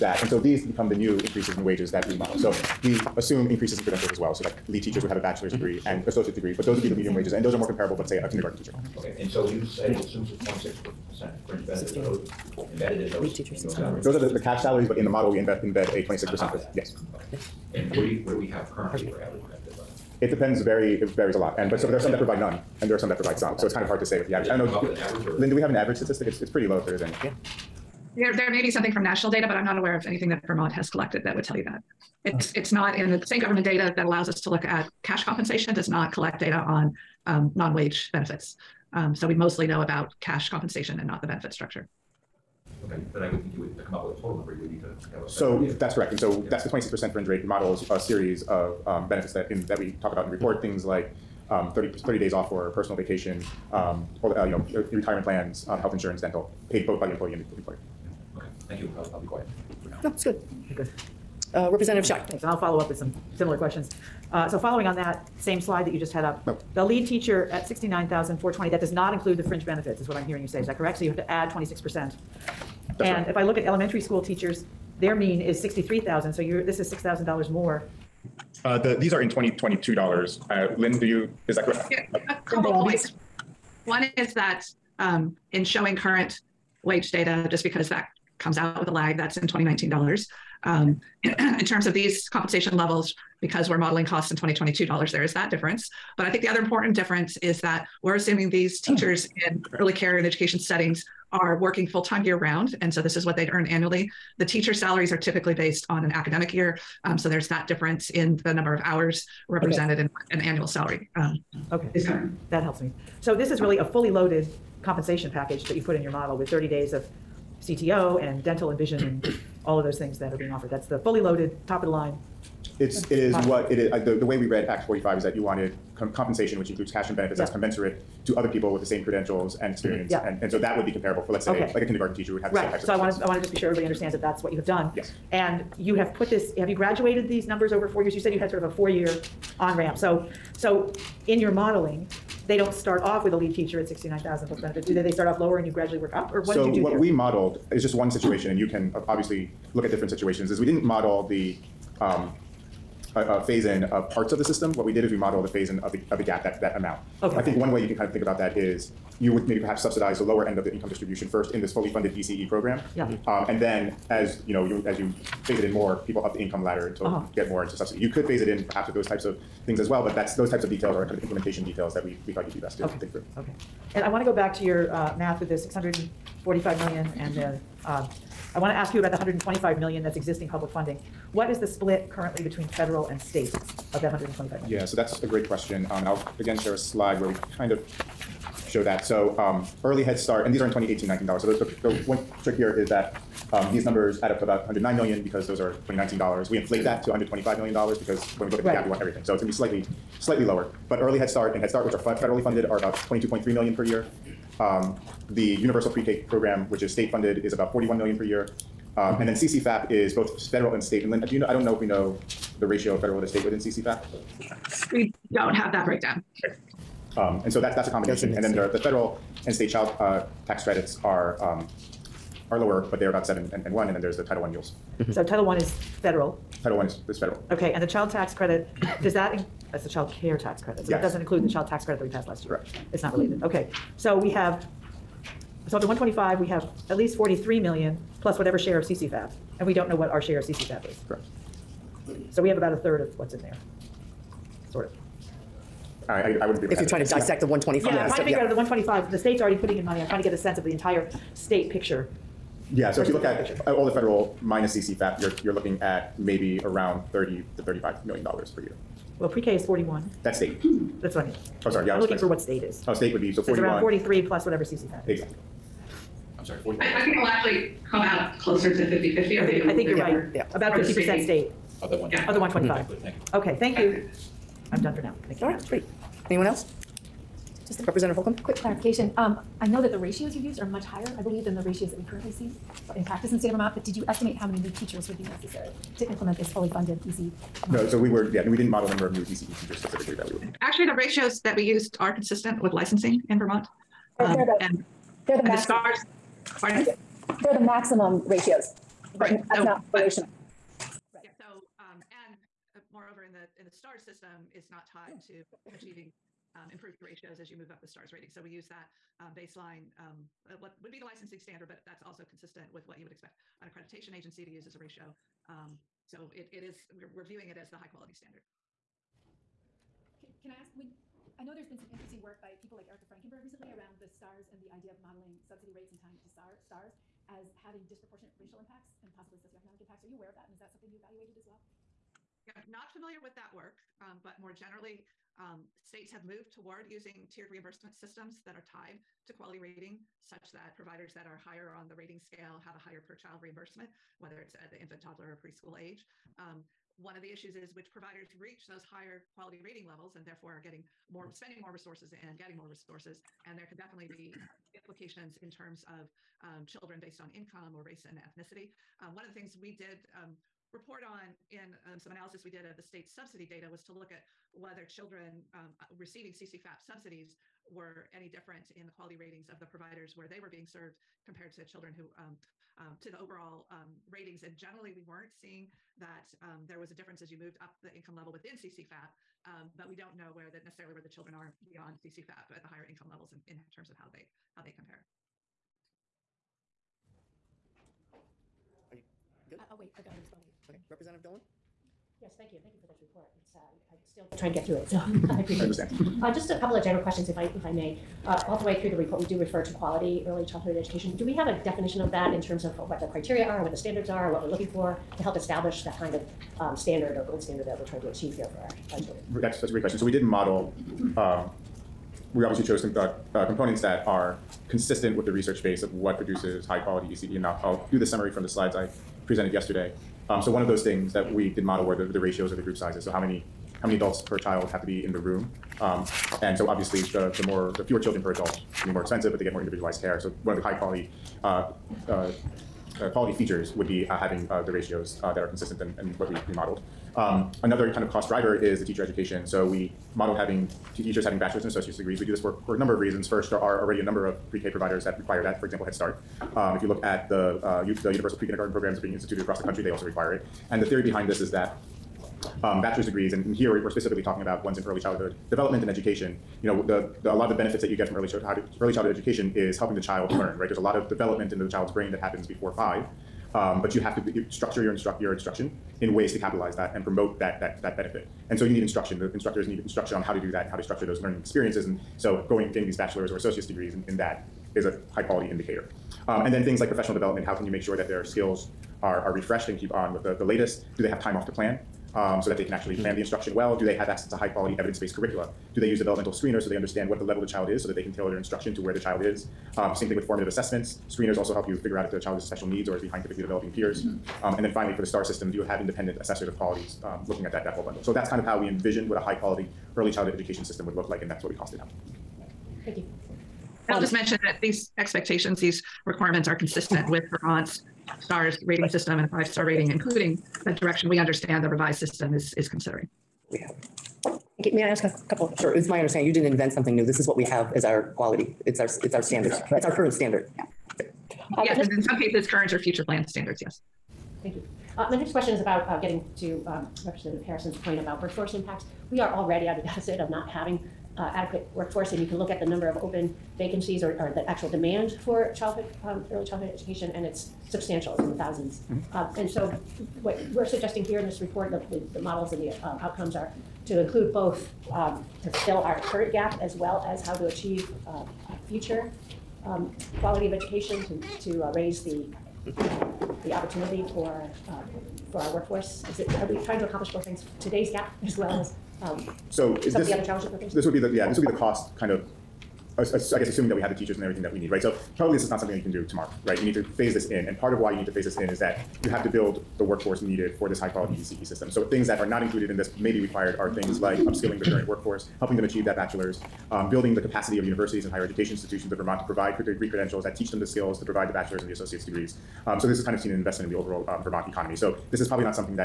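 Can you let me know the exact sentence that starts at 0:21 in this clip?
And, but so but there are some that provide none and there are some that provide some.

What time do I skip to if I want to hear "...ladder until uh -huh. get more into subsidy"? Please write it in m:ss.
2:46.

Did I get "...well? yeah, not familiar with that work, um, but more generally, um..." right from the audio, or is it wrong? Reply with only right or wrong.
right.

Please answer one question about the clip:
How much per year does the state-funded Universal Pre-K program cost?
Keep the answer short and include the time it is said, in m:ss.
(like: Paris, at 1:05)
41 million, at 3:27.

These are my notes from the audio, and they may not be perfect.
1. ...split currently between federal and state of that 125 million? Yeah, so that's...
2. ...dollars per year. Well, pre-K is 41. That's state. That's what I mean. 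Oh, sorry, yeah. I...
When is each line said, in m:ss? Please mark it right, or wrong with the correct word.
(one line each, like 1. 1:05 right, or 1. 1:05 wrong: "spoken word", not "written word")
1. 3:01 right
2. 4:18 right.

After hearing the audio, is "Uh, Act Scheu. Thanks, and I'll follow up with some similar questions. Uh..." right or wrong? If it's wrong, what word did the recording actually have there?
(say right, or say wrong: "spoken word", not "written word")
wrong: "Representative", not "Act".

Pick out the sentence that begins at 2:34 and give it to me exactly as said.
What we did is we modeled a phase in of the, of the gap, that, that amount.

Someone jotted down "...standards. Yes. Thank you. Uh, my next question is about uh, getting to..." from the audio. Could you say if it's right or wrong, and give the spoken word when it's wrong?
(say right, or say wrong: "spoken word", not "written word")
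right.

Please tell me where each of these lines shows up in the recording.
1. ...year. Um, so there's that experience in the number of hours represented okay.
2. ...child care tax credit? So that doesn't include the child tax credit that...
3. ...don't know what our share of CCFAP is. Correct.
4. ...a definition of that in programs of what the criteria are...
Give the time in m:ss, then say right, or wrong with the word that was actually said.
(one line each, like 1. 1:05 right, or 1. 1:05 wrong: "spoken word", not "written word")
1. 1:46 wrong: "difference", not "experience"
2. 3:49 right
3. 3:59 right
4. 6:41 wrong: "terms", not "programs".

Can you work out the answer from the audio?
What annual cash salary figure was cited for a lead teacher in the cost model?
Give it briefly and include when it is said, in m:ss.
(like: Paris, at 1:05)
69,420, at 1:07.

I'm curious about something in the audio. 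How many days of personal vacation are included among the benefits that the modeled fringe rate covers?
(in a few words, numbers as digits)
30.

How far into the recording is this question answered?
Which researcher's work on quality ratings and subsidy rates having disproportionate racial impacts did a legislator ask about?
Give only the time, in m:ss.
5:22.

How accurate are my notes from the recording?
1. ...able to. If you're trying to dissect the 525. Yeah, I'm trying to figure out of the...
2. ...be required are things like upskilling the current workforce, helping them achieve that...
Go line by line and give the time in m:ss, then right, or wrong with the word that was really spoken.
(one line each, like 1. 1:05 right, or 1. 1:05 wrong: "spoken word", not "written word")
1. 4:06 wrong: "125", not "525"
2. 9:33 right.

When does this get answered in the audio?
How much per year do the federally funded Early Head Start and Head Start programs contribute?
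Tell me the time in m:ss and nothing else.
3:22.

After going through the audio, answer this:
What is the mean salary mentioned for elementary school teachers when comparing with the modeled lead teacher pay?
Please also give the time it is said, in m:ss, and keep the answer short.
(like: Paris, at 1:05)
63,000, at 1:15.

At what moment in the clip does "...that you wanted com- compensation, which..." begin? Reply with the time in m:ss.
2:05.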